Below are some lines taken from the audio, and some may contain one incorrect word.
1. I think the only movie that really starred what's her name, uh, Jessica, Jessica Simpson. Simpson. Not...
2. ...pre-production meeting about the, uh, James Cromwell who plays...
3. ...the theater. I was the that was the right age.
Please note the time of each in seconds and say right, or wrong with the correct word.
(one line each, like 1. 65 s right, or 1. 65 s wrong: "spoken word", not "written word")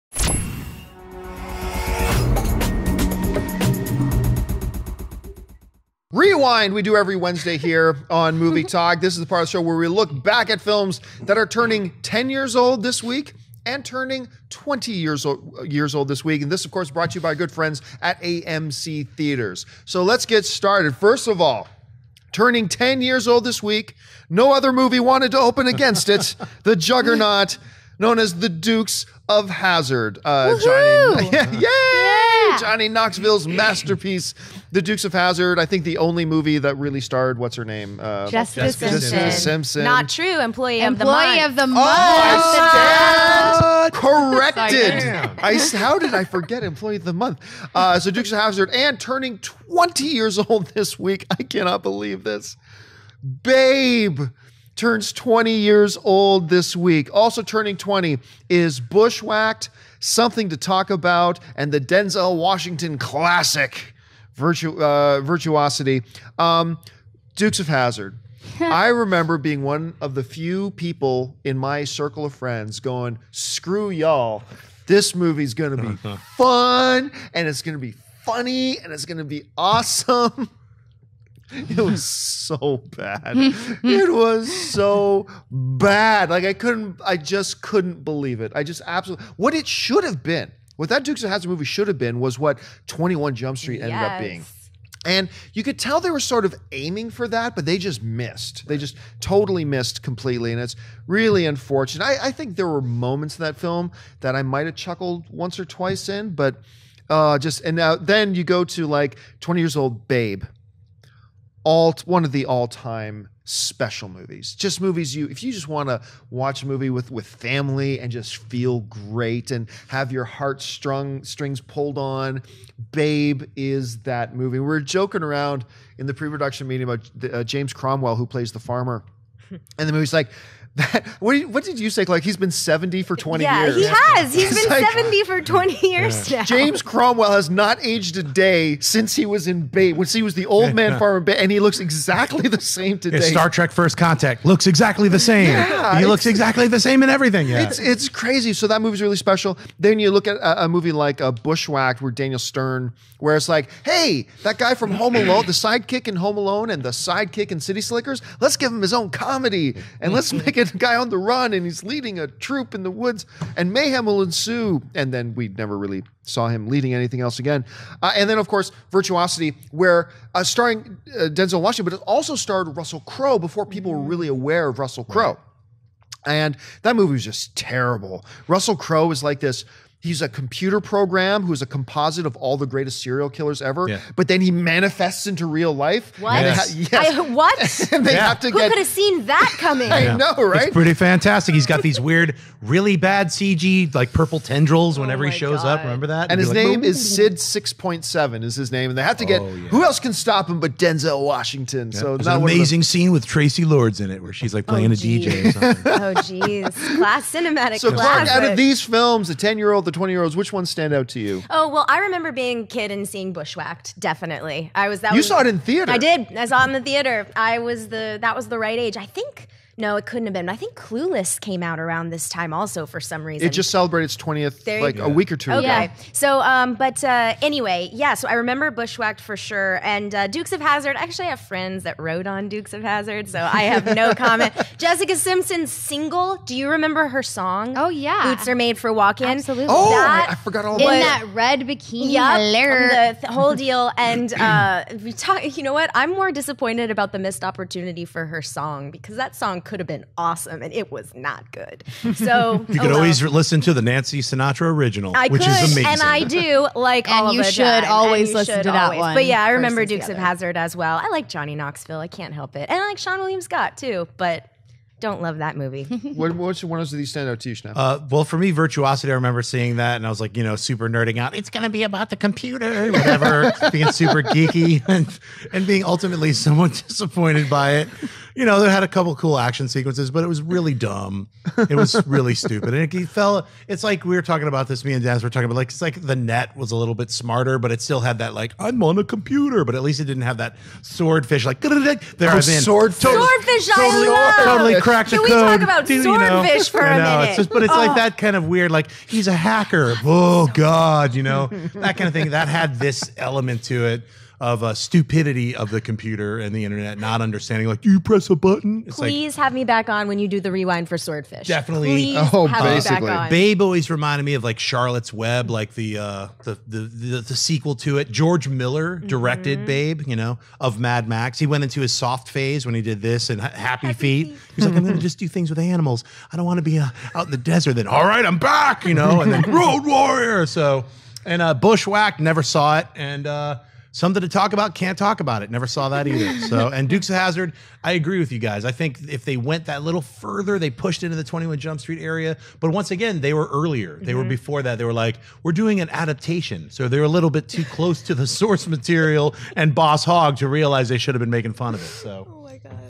1. 35 s right
2. 126 s right
3. 216 s right.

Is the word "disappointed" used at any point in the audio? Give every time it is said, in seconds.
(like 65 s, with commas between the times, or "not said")
246 s, 276 s.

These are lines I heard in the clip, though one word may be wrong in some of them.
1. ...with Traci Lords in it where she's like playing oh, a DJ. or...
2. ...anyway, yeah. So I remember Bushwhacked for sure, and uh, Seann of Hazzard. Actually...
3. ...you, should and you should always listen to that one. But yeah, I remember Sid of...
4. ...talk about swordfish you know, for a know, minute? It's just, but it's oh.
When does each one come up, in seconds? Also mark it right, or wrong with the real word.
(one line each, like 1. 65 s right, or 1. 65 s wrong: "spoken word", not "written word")
1. 203 s right
2. 227 s wrong: "Dukes", not "Seann"
3. 257 s wrong: "Dukes", not "Sid"
4. 295 s right.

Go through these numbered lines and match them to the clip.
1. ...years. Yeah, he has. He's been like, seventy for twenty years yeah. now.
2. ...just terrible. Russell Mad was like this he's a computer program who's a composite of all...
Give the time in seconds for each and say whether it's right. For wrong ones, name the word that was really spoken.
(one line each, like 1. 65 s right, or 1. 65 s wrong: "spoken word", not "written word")
1. 133 s right
2. 177 s wrong: "Crowe", not "Mad".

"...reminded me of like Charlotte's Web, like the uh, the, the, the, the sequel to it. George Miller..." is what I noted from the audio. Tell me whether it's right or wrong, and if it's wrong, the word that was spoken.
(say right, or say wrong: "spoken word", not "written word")
right.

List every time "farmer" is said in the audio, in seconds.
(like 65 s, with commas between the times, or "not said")
128 s, 140 s.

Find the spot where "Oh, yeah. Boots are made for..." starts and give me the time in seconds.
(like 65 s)
237 s.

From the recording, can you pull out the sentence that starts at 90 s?
What that Dukes of Hazzard movie should have been was what Twenty One Jump Street ended yes.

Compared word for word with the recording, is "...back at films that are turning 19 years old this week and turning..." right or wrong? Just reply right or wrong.
wrong.